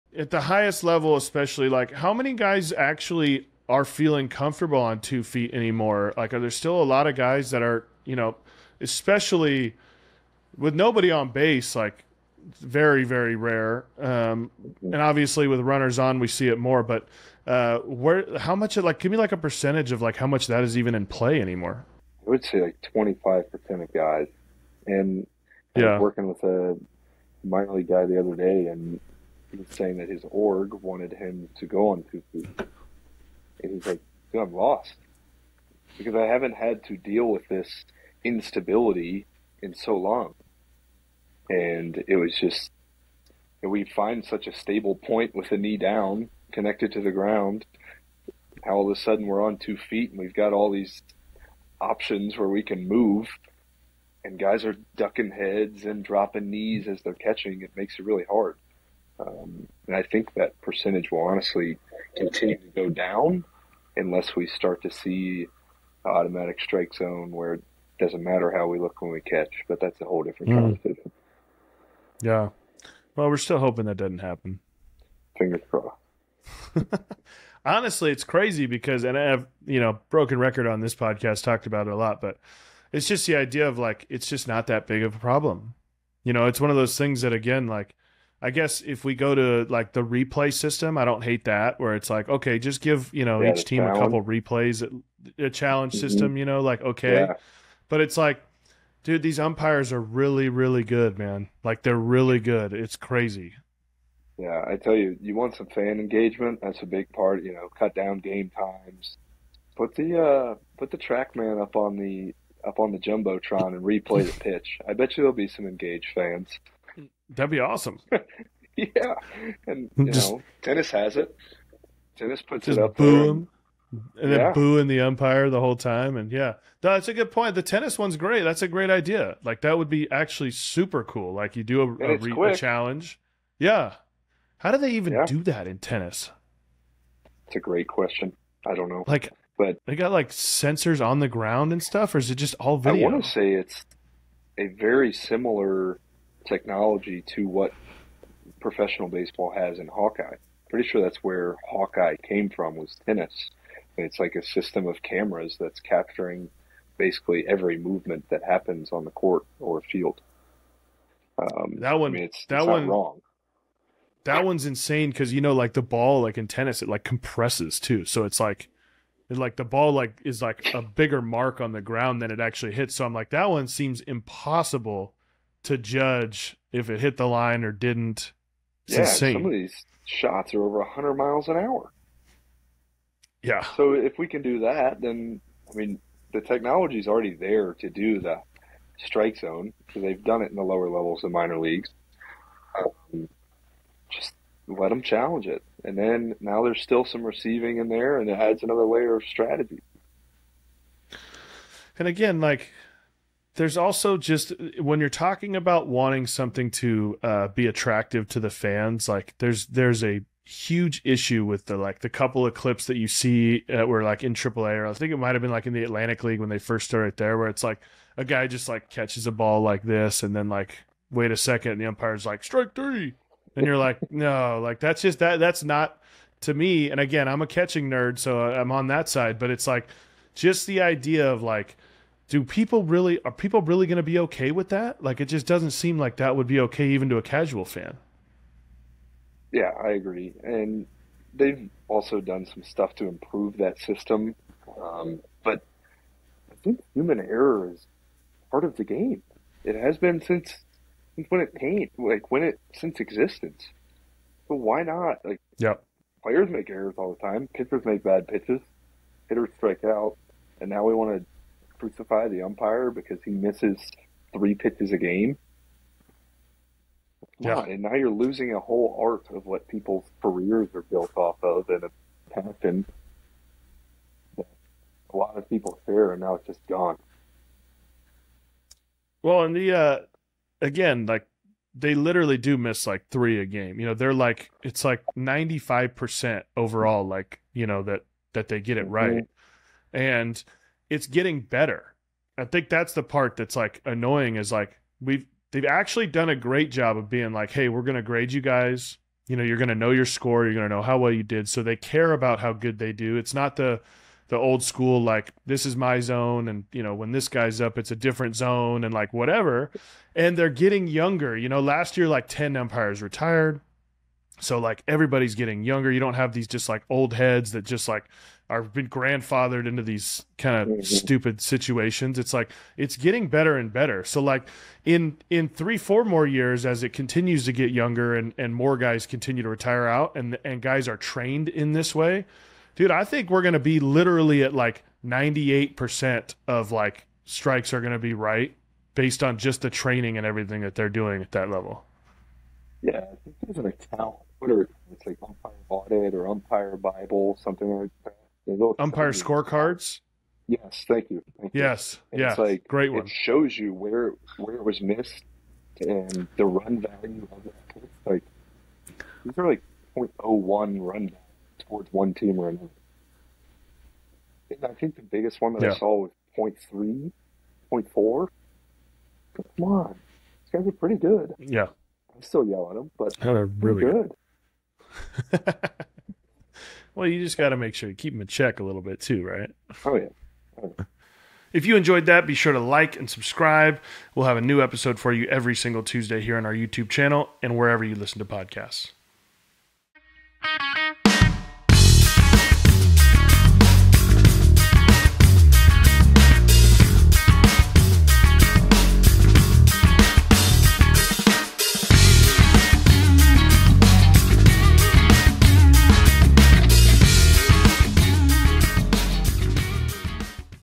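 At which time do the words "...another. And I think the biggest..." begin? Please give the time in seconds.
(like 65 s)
362 s.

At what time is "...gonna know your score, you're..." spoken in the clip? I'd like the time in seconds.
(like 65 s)
299 s.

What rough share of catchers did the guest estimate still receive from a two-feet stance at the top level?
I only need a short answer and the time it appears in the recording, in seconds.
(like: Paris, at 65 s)
25%, at 22 s.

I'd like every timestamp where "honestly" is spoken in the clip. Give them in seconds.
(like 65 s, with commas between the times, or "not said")
61 s, 77 s.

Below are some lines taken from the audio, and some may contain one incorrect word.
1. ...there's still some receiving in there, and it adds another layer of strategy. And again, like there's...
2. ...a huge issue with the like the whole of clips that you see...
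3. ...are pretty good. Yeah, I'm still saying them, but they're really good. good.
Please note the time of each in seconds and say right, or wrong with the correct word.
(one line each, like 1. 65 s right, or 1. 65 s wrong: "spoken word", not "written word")
1. 196 s right
2. 210 s wrong: "couple", not "whole"
3. 370 s wrong: "yelling", not "saying".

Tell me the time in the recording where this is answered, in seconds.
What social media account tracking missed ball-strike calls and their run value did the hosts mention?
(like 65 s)
348 s.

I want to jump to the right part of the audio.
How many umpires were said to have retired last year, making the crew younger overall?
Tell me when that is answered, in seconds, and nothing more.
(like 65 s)
312 s.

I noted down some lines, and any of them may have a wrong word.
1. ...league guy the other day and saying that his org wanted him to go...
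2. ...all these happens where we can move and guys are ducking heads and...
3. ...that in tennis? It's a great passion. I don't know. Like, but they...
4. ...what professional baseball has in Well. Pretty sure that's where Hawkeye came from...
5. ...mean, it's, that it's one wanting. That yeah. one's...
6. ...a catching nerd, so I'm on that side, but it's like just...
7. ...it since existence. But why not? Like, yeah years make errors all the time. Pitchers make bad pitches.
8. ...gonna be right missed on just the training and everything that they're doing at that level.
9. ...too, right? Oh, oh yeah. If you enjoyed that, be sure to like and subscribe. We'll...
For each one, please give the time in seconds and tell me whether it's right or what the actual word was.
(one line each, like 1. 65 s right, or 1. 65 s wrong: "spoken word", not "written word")
1. 27 s right
2. 50 s wrong: "options", not "happens"
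3. 135 s wrong: "question", not "passion"
4. 147 s wrong: "Hawkeye", not "Well"
5. 162 s wrong: "wrong", not "wanting"
6. 227 s right
7. 252 s wrong: "players", not "years"
8. 337 s wrong: "based", not "missed"
9. 378 s right.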